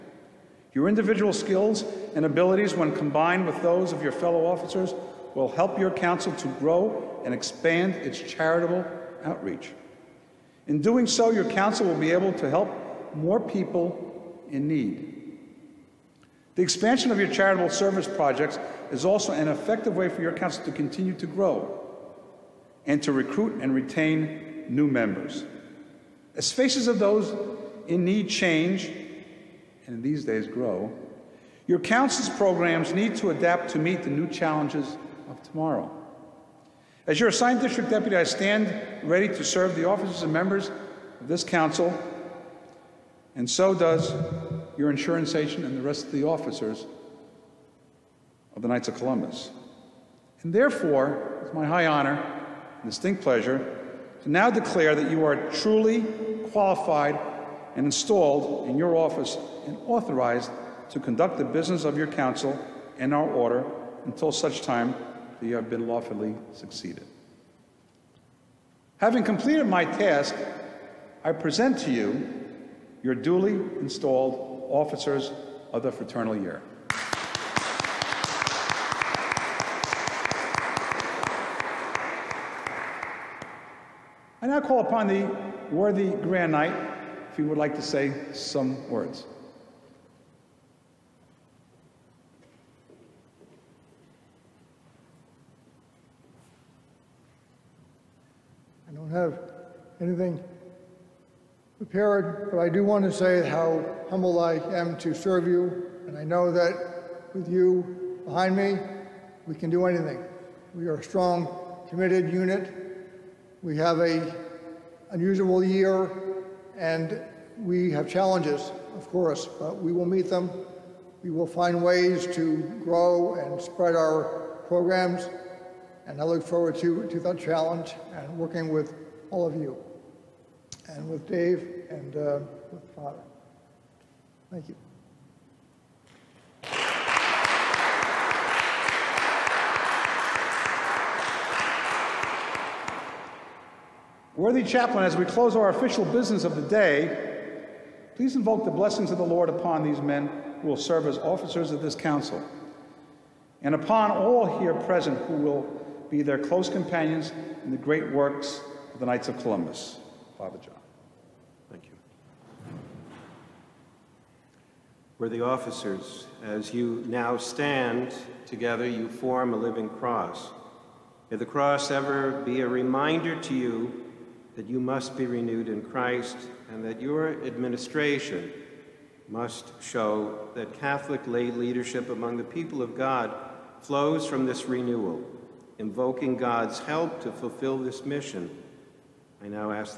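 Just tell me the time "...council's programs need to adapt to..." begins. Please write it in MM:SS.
00:31.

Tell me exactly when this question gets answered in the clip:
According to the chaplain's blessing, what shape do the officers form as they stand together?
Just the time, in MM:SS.
02:49.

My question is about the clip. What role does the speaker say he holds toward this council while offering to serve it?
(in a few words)
district deputy.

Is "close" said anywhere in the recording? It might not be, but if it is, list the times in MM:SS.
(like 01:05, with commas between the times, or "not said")
02:25, 02:36.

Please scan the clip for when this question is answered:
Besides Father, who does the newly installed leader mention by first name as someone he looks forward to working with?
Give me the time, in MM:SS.
02:11.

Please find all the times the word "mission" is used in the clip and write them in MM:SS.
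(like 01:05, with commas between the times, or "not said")
03:08.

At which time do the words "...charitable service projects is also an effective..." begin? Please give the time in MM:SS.
00:17.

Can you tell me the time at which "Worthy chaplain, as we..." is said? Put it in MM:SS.
02:24.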